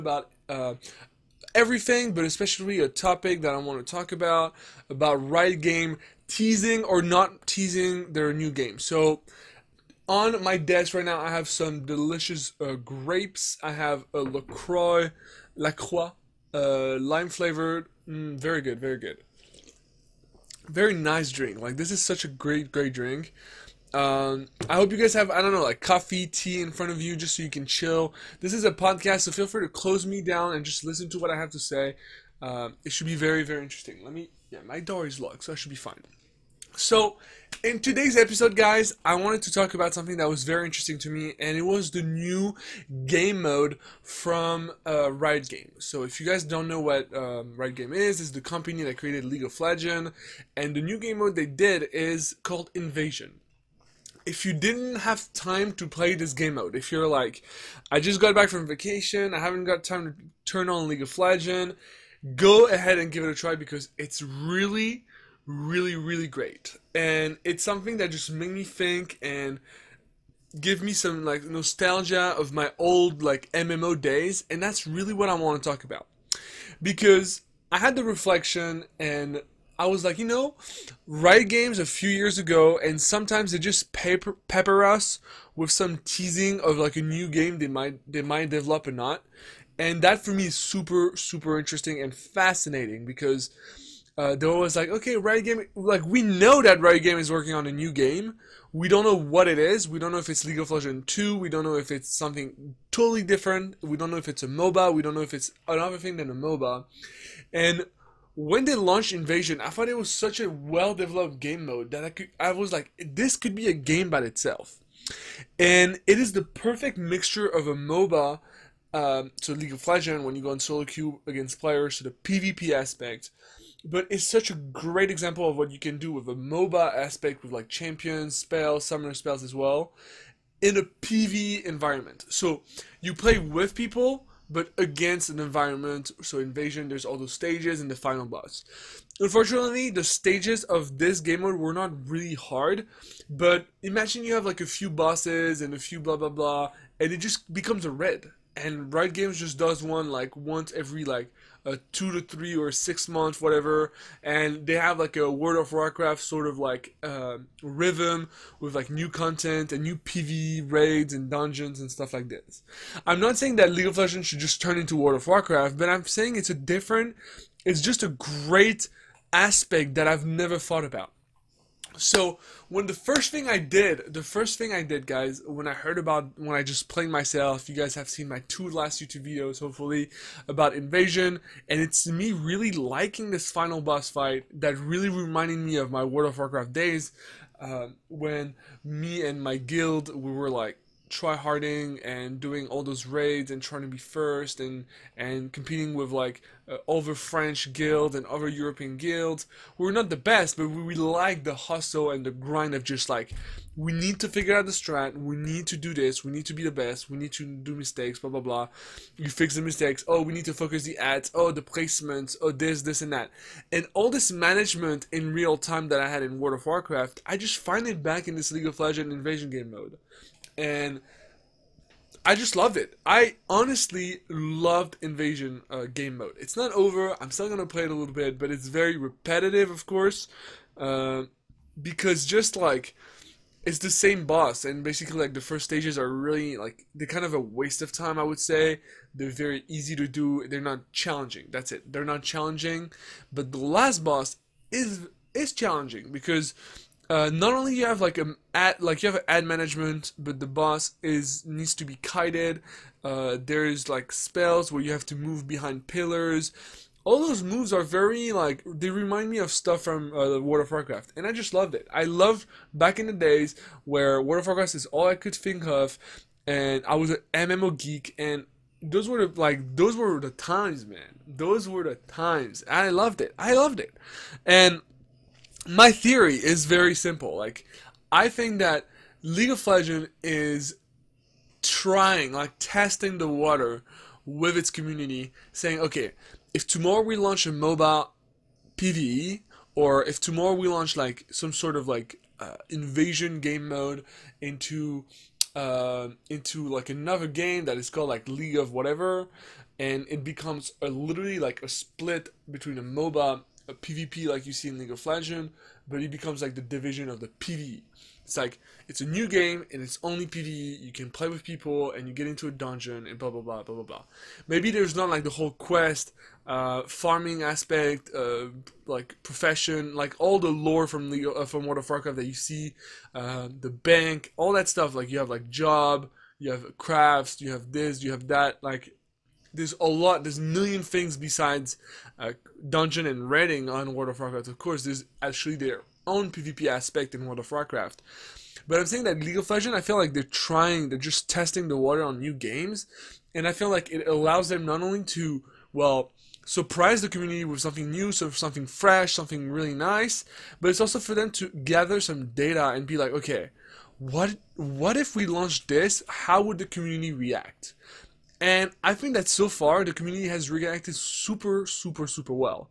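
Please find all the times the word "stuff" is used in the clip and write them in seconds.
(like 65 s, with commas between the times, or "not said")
161 s, 259 s, 324 s.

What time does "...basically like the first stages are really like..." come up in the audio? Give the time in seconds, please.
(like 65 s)
234 s.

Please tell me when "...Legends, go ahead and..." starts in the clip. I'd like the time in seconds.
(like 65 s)
61 s.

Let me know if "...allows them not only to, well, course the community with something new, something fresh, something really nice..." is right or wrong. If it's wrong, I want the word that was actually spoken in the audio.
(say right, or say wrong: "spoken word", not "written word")
wrong: "surprise", not "course".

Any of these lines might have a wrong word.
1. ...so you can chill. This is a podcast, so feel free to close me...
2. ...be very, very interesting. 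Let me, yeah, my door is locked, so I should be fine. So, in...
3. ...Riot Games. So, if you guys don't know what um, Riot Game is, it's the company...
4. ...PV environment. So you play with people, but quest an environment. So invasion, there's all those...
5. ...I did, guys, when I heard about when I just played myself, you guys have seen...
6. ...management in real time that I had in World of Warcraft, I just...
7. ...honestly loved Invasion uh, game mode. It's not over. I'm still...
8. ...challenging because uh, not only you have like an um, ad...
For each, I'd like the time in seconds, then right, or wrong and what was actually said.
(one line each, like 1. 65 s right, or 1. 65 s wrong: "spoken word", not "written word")
1. 27 s right
2. 33 s right
3. 45 s right
4. 130 s wrong: "against", not "quest"
5. 174 s right
6. 214 s right
7. 223 s right
8. 245 s right.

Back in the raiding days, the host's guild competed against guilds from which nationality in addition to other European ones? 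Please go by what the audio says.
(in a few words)
French.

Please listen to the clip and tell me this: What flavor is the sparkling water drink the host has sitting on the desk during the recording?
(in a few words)
Lime.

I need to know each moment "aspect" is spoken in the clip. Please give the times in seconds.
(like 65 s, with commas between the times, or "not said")
122 s, 126 s, 169 s, 317 s, 336 s.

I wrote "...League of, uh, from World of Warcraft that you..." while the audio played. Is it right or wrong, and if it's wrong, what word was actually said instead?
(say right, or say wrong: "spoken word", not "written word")
right.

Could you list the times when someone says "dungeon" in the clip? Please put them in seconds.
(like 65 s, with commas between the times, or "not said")
161 s, 312 s, 332 s.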